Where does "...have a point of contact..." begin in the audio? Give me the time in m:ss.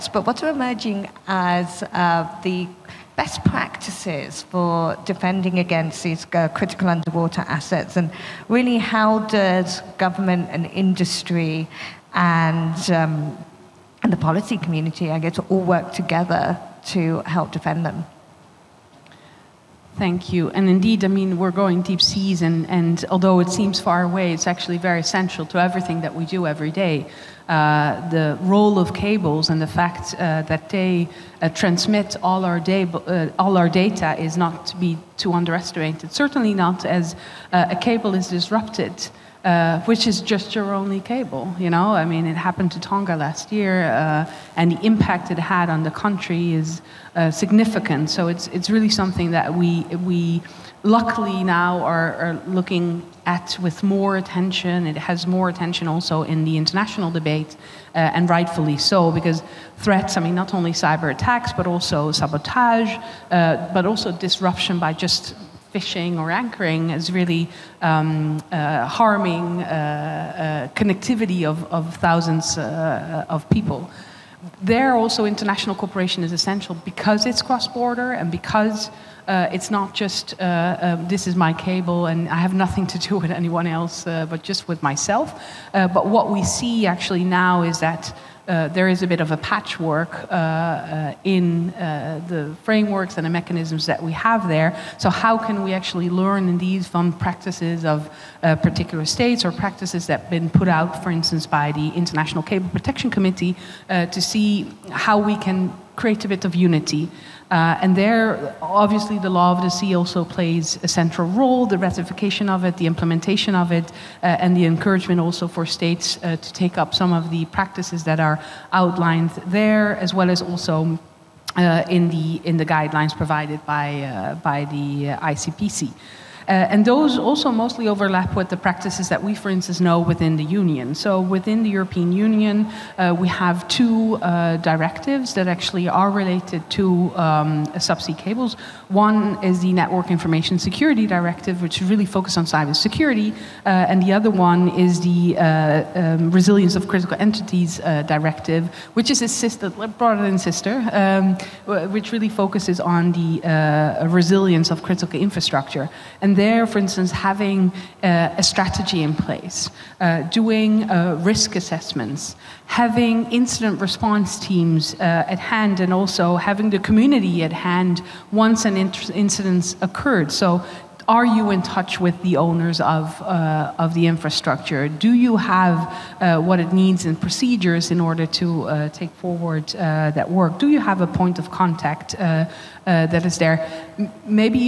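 3:00.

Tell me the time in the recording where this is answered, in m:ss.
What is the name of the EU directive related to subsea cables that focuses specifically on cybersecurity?
2:19.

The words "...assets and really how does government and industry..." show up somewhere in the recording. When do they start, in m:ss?
0:07.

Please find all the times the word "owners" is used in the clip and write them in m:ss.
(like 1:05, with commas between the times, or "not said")
2:52.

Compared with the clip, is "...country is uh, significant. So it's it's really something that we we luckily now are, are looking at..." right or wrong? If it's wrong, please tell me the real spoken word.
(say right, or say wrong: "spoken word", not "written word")
right.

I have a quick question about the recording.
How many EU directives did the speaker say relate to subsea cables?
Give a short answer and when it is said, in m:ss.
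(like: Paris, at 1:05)
2, at 2:13.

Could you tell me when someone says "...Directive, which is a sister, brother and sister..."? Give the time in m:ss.
2:28.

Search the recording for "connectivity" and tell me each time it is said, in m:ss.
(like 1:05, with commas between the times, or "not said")
1:10.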